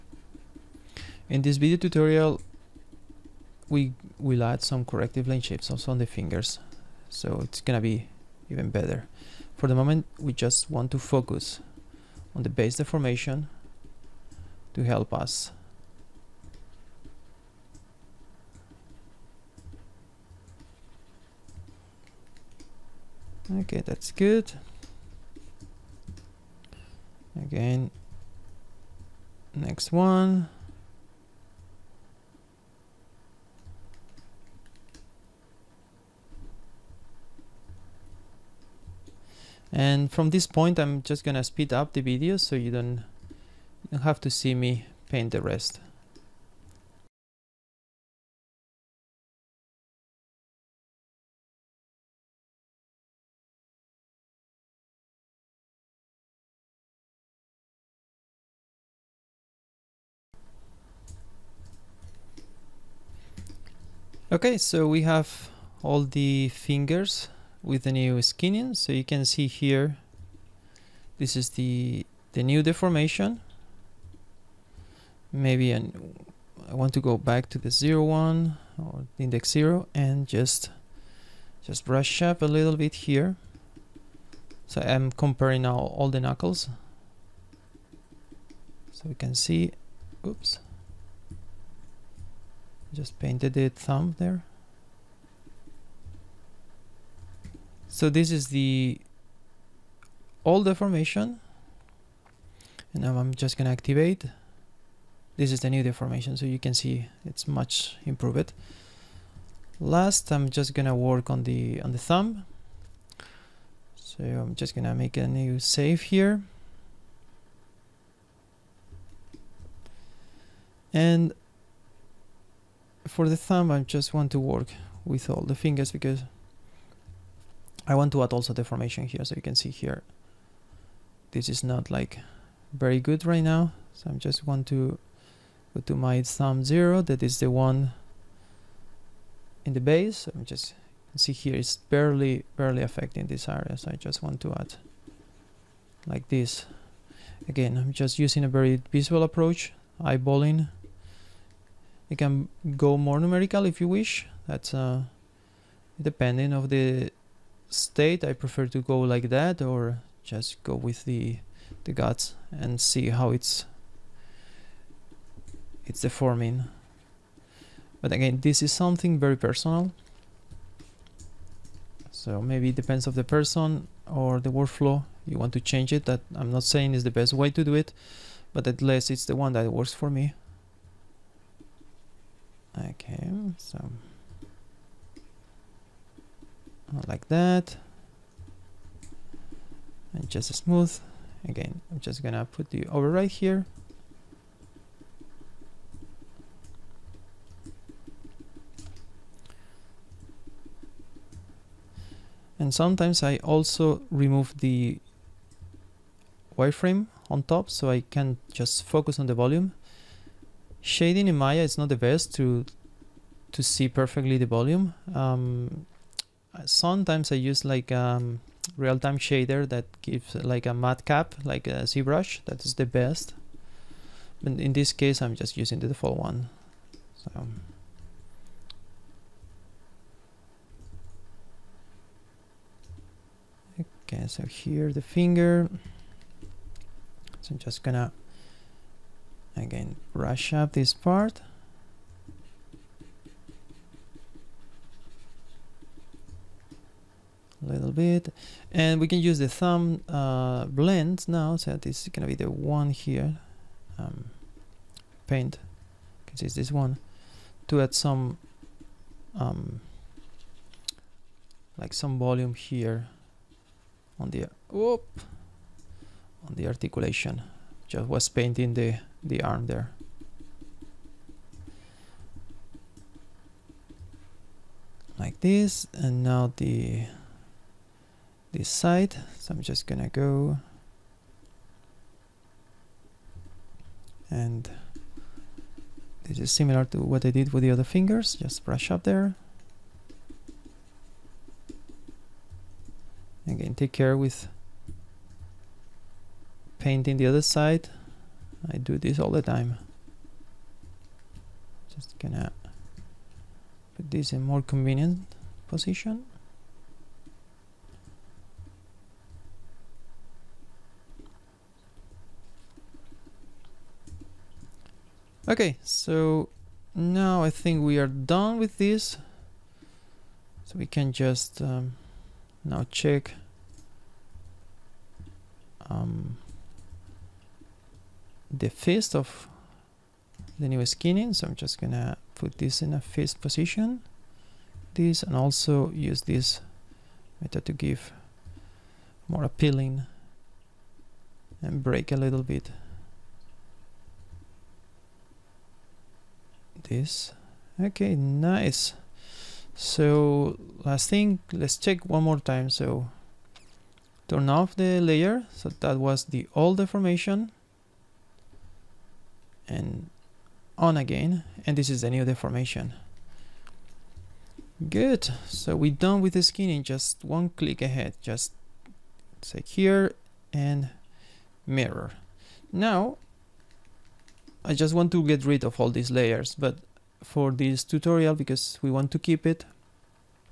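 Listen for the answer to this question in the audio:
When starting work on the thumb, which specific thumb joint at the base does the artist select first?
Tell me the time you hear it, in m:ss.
2:16.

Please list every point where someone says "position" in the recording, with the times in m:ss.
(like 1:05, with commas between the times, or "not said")
5:05, 5:33.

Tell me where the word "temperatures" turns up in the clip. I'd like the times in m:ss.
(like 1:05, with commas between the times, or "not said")
not said.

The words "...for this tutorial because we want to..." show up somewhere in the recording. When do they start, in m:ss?
6:17.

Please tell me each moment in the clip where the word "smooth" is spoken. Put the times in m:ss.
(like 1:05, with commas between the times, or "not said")
3:10.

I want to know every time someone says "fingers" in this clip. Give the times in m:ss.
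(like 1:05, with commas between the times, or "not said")
0:06, 1:06, 2:05, 3:55, 4:47.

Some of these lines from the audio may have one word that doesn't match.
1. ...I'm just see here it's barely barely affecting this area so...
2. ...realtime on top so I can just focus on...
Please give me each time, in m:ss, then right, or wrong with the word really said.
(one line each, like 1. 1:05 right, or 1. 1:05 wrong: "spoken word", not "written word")
1. 2:20 right
2. 3:26 wrong: "wireframe", not "realtime".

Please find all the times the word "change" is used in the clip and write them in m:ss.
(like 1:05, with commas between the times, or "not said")
2:55.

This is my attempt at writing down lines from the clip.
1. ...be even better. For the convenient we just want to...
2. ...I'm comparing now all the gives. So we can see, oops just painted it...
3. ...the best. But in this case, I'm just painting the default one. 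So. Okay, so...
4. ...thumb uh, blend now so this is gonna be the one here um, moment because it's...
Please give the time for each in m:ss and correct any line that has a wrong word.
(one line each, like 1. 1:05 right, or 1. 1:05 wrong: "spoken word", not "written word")
1. 0:07 wrong: "moment", not "convenient"
2. 1:24 wrong: "knuckles", not "gives"
3. 3:42 wrong: "using", not "painting"
4. 4:09 wrong: "paint", not "moment".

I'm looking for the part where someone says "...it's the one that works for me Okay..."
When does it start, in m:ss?
2:59.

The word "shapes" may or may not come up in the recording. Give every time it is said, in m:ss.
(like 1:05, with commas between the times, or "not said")
0:05.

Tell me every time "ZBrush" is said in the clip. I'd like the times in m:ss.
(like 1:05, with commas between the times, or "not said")
3:41.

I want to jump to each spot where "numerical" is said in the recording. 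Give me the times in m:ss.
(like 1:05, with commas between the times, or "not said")
2:33.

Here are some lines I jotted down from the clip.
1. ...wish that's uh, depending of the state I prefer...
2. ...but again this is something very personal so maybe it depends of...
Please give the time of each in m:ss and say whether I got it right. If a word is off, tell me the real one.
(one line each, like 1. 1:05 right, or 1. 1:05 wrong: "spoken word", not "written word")
1. 2:33 right
2. 2:47 right.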